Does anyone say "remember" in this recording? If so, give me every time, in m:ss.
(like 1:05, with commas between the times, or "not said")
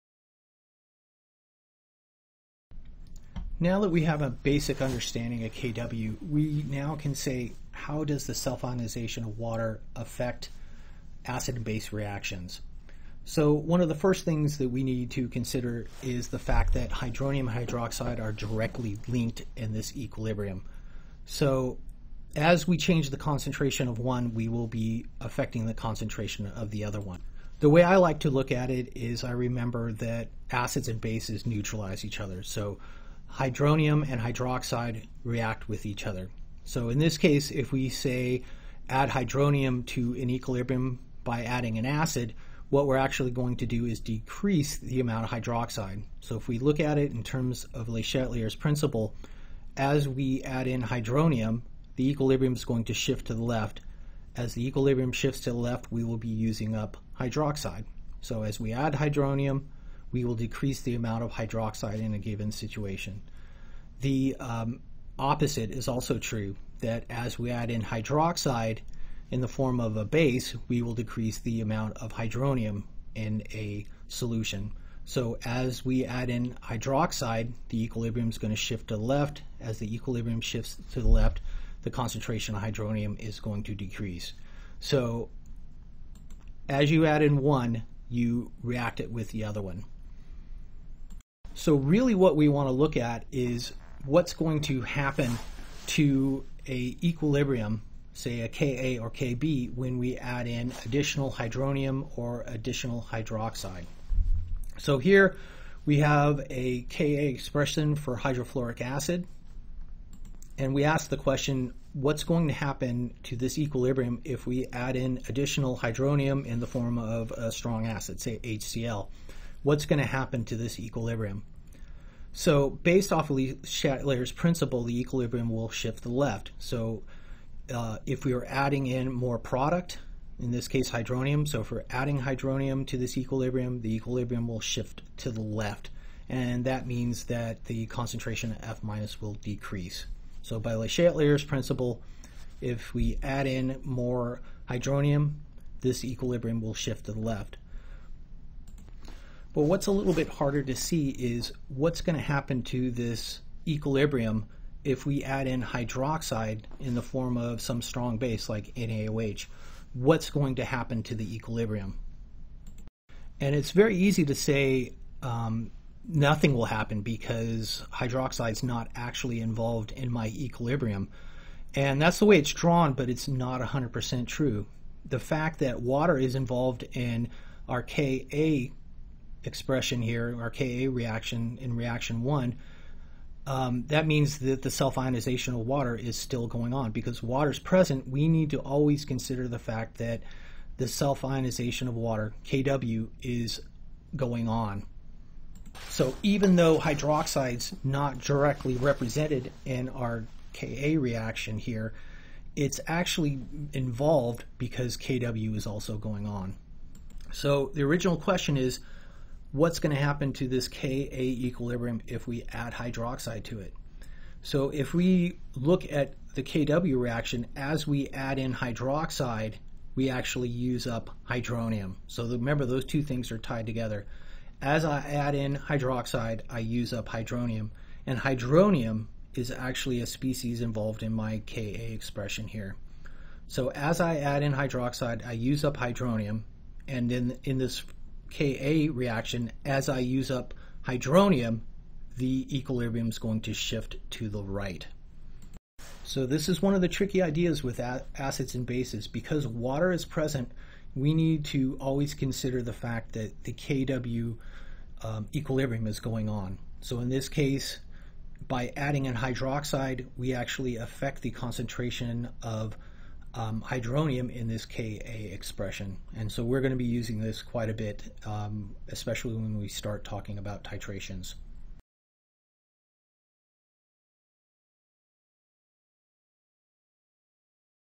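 0:29, 3:42.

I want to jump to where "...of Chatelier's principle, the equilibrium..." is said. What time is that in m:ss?
2:03.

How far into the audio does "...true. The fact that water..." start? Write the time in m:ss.
2:54.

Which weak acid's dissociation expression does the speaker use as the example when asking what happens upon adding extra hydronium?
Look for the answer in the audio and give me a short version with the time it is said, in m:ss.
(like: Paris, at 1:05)
hydrofluoric acid, at 1:48.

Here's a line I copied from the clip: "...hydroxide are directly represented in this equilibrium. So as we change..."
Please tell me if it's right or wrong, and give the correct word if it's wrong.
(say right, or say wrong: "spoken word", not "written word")
wrong: "linked", not "represented".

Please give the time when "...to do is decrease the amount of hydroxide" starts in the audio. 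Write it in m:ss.
0:43.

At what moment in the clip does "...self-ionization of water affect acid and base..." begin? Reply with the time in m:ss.
0:08.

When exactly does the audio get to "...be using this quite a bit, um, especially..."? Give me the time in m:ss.
4:26.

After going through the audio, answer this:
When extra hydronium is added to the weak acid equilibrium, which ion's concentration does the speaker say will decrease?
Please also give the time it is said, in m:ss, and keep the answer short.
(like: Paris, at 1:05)
F minus, at 2:18.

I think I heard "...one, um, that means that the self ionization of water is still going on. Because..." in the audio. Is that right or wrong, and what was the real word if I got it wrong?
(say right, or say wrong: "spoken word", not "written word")
right.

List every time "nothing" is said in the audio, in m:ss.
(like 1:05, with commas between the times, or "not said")
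2:46.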